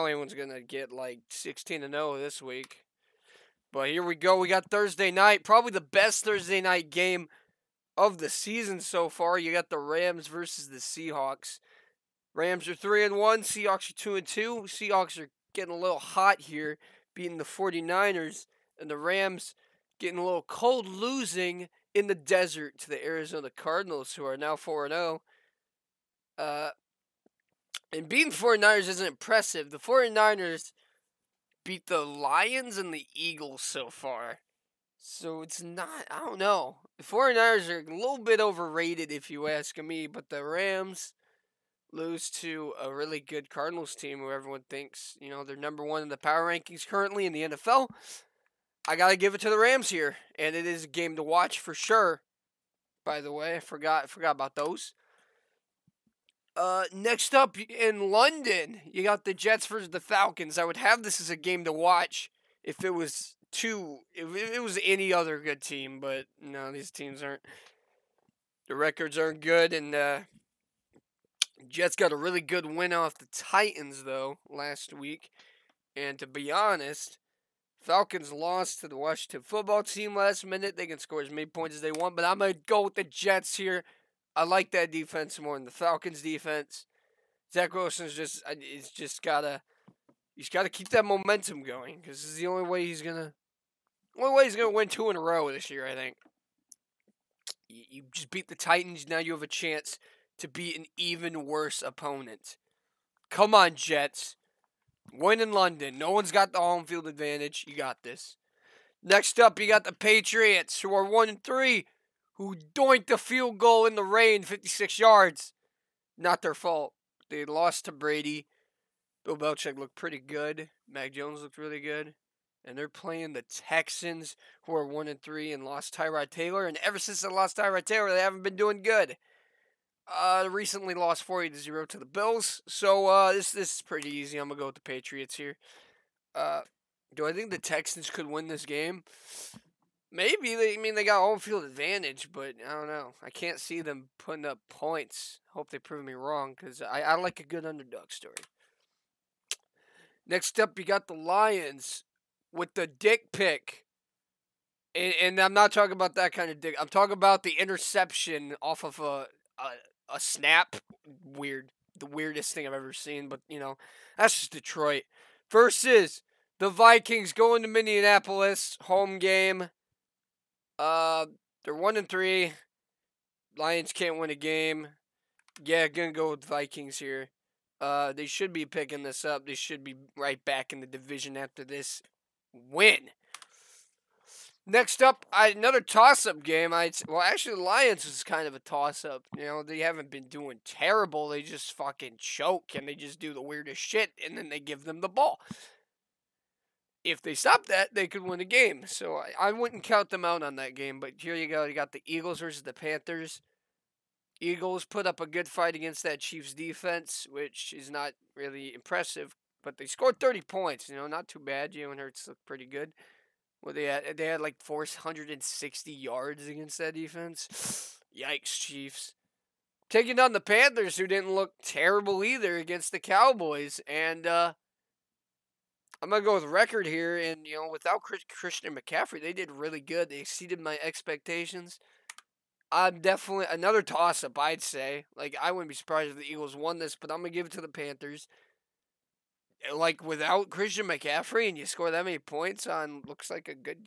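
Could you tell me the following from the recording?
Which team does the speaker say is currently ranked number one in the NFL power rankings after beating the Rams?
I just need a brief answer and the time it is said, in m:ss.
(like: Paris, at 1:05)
Arizona Cardinals, at 0:23.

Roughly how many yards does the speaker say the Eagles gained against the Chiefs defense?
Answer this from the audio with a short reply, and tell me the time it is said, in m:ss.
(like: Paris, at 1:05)
460, at 3:34.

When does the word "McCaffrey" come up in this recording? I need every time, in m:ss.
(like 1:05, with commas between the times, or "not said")
3:48, 4:00.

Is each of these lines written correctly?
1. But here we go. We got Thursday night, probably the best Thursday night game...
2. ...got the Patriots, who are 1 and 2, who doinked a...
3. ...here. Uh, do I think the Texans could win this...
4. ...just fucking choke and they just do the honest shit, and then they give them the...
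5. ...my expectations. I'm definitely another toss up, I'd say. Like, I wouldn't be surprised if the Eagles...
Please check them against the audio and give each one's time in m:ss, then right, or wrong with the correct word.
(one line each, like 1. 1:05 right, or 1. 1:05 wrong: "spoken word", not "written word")
1. 0:03 right
2. 1:49 wrong: "3", not "2"
3. 2:15 right
4. 3:11 wrong: "weirdest", not "honest"
5. 3:50 right.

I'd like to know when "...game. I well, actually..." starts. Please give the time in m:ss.
3:06.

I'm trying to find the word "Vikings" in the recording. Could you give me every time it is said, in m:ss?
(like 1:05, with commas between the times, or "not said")
2:46, 2:56.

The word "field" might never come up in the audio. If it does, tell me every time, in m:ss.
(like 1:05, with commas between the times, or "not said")
1:46, 1:53, 2:21.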